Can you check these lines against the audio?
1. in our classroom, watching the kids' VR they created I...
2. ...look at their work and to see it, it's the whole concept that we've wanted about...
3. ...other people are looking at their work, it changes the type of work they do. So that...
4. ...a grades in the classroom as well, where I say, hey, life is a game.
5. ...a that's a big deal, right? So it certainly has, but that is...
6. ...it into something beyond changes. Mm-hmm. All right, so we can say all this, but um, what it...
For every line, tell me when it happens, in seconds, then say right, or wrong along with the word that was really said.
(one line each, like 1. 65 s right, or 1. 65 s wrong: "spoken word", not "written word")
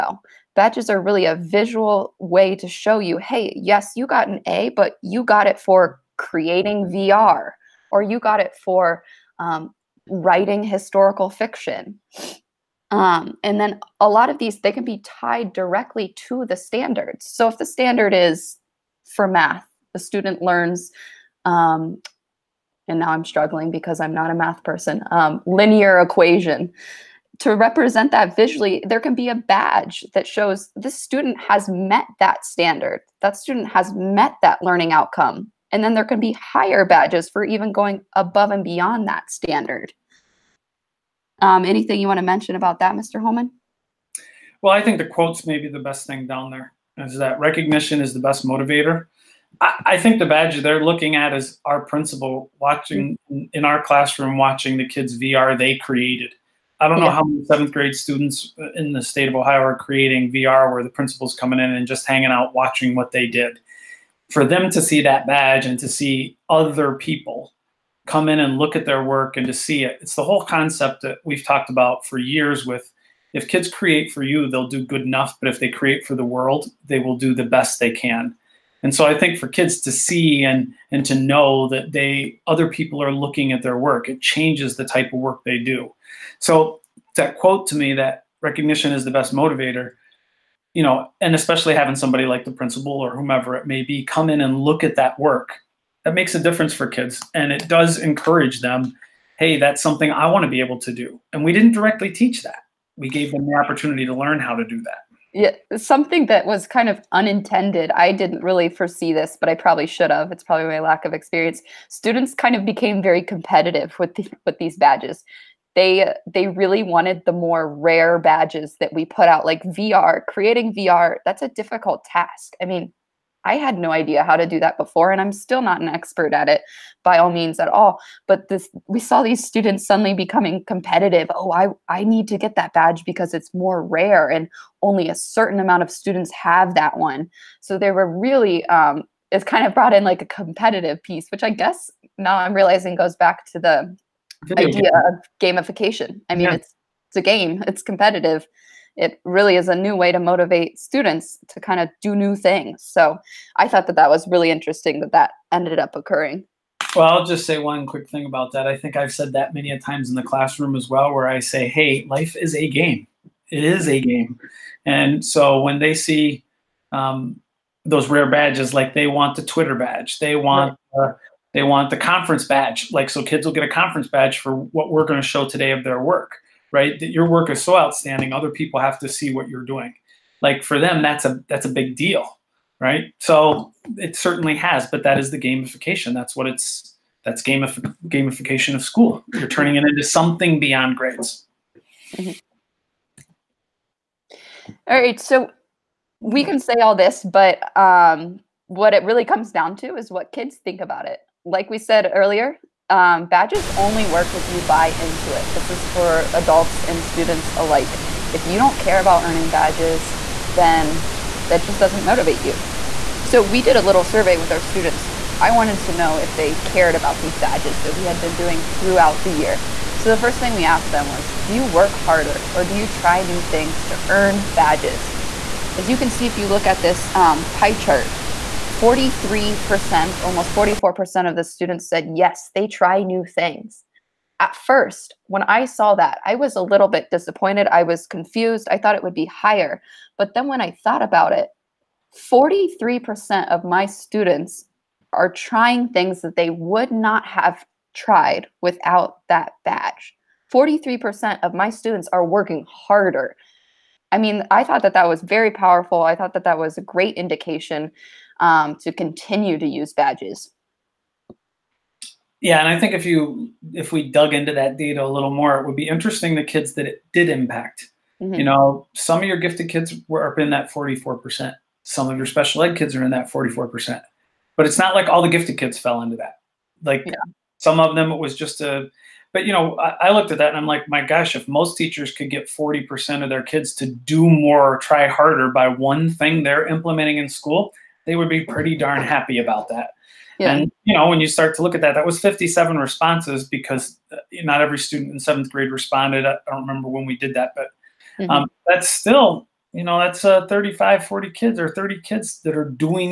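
1. 53 s right
2. 68 s wrong: "talked", not "wanted"
3. 82 s right
4. 159 s wrong: "times", not "grades"
5. 181 s right
6. 189 s wrong: "grades", not "changes".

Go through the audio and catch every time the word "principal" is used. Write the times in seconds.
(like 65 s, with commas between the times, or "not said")
51 s, 60 s, 92 s.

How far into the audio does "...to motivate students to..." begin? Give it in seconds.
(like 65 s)
150 s.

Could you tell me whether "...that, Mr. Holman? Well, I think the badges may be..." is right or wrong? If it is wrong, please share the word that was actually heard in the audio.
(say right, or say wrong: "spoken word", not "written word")
wrong: "quotes", not "badges".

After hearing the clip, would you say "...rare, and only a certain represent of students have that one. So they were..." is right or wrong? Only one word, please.
wrong.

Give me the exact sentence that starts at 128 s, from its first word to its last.
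But this, we saw these students suddenly becoming competitive.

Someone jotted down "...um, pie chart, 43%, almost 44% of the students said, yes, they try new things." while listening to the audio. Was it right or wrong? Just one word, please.
right.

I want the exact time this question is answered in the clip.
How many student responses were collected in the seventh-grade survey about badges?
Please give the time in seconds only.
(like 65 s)
292 s.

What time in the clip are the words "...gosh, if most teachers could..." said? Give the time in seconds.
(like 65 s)
281 s.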